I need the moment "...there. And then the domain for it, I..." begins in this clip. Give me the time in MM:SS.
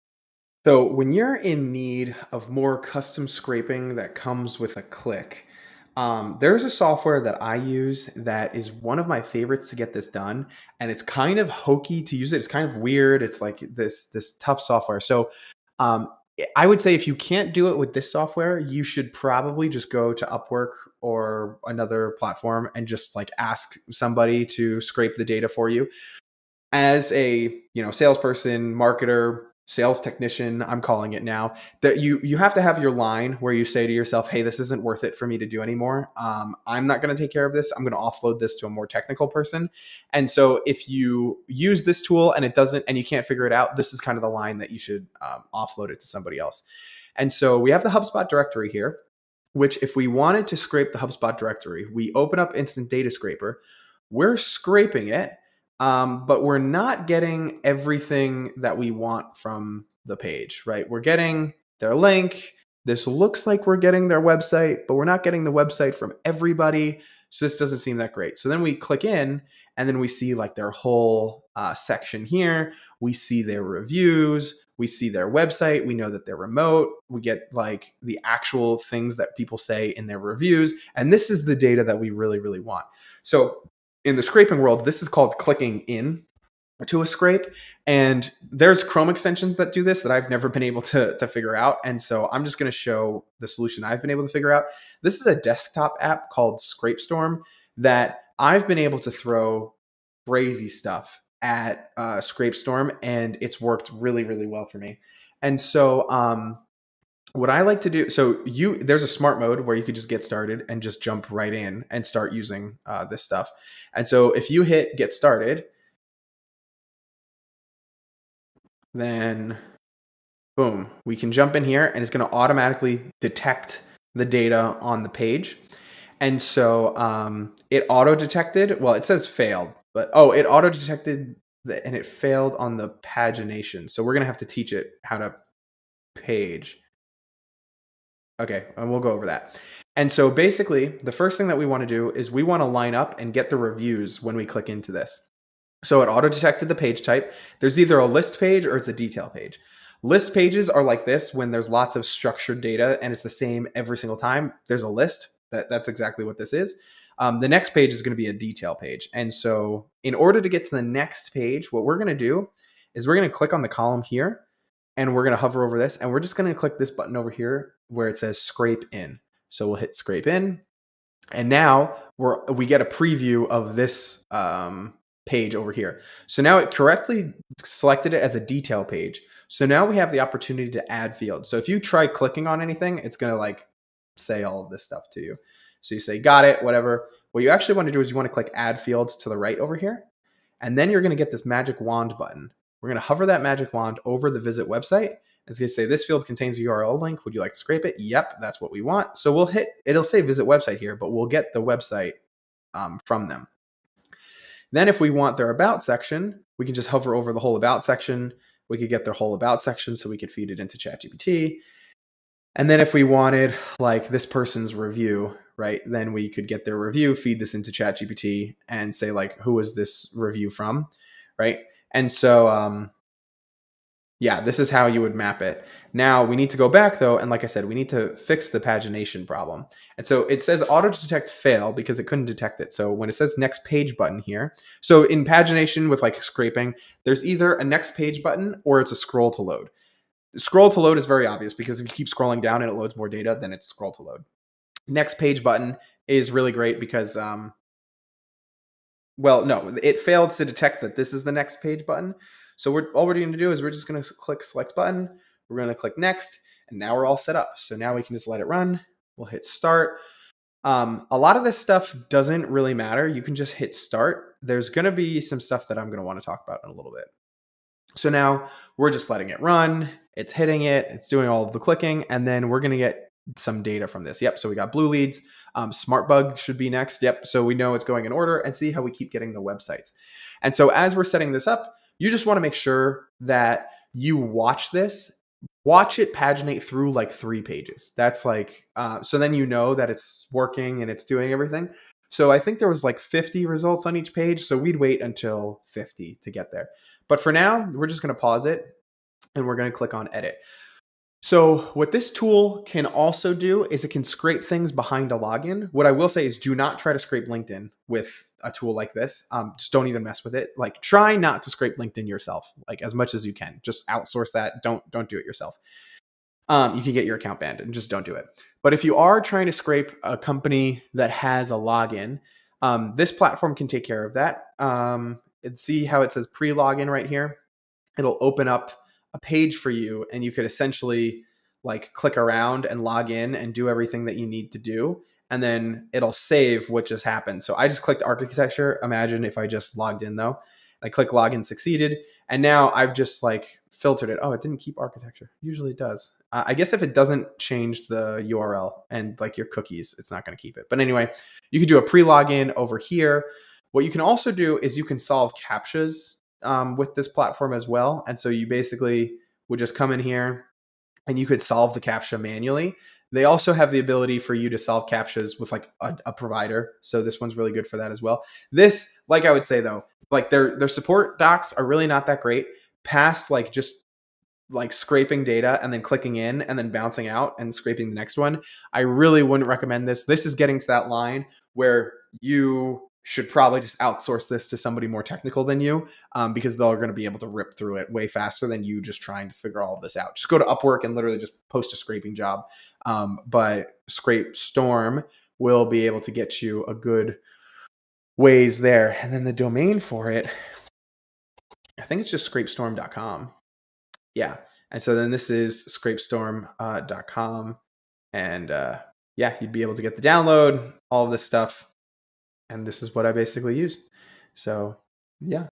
06:38.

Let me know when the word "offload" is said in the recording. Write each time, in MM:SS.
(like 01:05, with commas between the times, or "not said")
00:37, 00:45.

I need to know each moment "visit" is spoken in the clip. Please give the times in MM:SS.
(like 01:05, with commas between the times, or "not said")
03:14, 03:20.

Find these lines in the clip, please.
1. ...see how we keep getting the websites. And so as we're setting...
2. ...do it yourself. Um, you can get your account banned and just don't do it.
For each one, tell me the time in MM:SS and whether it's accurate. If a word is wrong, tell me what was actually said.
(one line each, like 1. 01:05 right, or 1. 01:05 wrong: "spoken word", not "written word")
1. 04:38 right
2. 05:15 right.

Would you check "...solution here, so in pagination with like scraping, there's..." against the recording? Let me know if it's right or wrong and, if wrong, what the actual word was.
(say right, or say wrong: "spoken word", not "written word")
wrong: "button", not "solution".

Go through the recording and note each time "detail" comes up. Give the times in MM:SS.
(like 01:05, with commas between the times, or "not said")
02:28, 02:38, 02:58.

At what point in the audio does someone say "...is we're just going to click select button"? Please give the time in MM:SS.
04:13.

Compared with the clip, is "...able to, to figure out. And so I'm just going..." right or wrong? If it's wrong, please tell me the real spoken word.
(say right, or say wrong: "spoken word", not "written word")
right.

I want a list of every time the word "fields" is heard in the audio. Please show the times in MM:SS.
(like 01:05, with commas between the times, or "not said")
03:01, 03:08, 03:16.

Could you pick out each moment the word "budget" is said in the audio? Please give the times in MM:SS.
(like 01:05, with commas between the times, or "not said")
not said.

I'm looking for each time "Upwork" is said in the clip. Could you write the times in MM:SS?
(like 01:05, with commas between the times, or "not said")
00:20, 06:30.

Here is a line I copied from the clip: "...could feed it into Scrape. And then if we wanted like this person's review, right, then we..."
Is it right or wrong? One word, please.
wrong.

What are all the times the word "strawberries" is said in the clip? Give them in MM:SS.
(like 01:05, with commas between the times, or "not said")
not said.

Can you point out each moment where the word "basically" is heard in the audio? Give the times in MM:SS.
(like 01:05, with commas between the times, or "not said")
02:20, 05:58, 06:53.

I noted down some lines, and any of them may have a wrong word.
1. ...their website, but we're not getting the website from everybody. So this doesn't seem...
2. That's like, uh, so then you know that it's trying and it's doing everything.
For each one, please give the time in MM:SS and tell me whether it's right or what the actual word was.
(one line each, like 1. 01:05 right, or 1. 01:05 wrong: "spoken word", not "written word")
1. 01:04 right
2. 04:47 wrong: "working", not "trying".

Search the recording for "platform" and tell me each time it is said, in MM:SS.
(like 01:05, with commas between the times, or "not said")
00:22, 05:23, 05:57.